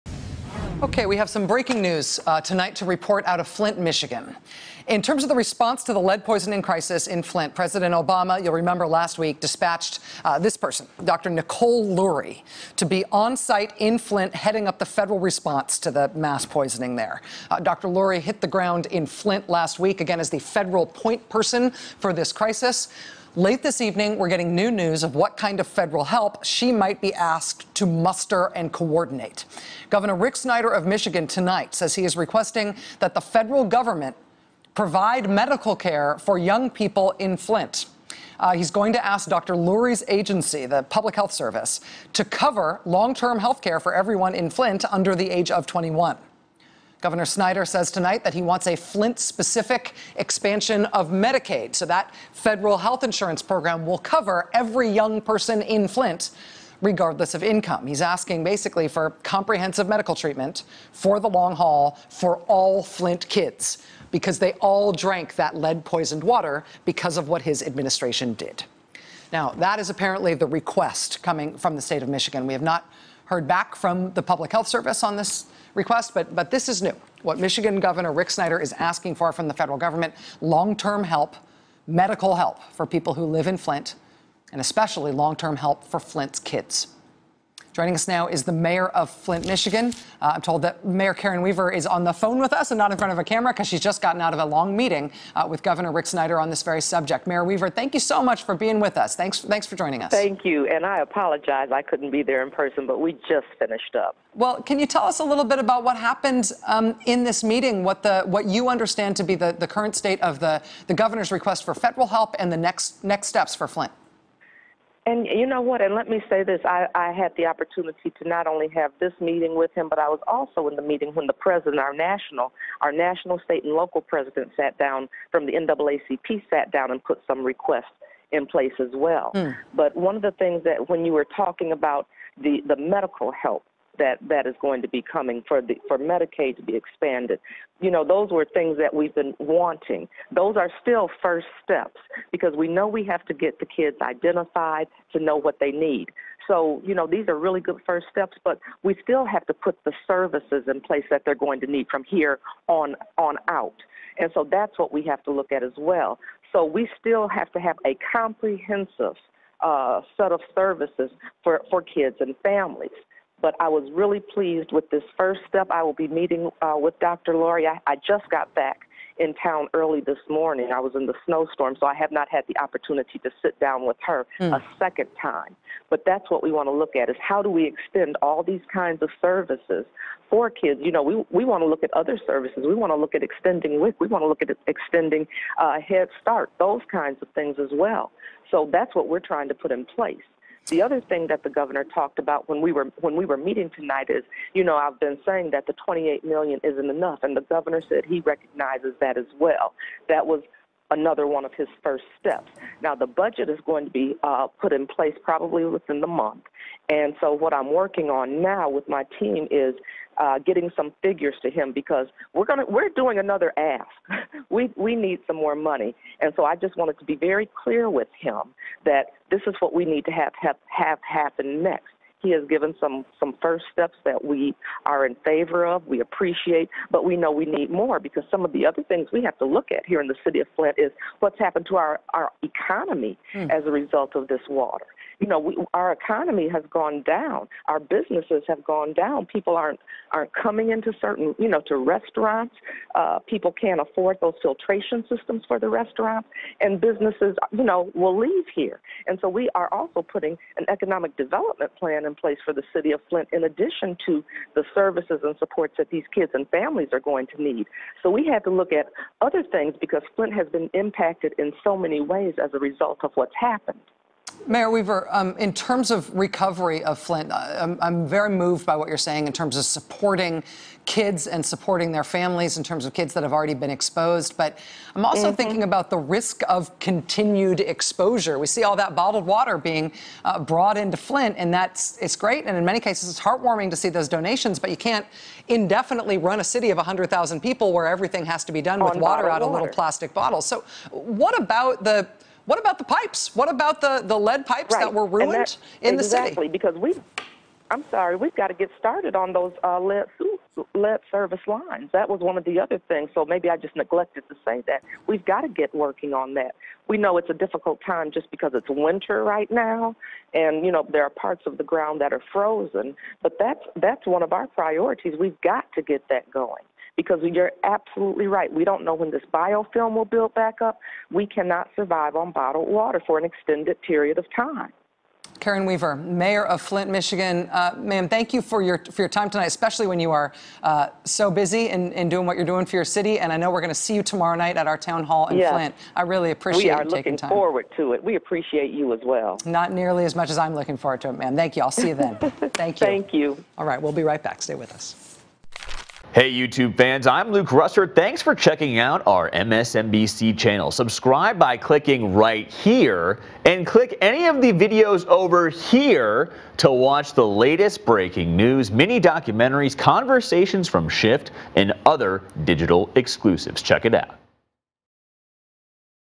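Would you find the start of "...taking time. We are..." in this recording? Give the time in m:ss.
5:36.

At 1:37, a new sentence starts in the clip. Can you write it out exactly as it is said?
Mayor Weaver, thank you so much for being with us.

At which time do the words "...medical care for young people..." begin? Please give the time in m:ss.
0:35.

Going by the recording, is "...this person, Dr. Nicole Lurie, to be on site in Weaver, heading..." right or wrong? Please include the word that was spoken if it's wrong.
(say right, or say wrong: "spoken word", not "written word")
wrong: "Flint", not "Weaver".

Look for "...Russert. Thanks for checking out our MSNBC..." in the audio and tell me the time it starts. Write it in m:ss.
5:47.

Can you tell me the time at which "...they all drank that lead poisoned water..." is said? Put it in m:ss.
1:04.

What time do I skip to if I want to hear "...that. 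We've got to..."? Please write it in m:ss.
5:04.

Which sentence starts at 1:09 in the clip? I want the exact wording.
Now, that is apparently the request coming from the state of Michigan.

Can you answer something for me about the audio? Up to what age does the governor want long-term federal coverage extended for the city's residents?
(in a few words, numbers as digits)
21.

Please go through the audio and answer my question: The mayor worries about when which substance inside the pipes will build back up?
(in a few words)
biofilm.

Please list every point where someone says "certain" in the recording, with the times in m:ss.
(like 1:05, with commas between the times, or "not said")
4:00.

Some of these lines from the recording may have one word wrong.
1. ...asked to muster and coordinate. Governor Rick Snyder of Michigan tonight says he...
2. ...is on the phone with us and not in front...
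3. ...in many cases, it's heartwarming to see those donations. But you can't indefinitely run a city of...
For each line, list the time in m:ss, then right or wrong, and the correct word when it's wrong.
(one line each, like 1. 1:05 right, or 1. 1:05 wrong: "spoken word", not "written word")
1. 0:27 right
2. 1:31 right
3. 4:42 right.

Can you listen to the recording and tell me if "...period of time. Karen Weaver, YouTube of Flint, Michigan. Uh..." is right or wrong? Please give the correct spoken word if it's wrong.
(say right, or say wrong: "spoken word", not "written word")
wrong: "Mayor", not "YouTube".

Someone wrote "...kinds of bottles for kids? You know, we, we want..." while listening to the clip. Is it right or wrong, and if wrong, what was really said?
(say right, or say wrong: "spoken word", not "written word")
wrong: "services", not "bottles".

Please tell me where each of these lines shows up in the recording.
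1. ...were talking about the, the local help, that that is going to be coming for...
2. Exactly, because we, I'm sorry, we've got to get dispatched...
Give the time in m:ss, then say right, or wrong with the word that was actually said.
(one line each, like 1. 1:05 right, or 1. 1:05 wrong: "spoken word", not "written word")
1. 2:11 wrong: "medical", not "local"
2. 4:56 wrong: "started", not "dispatched".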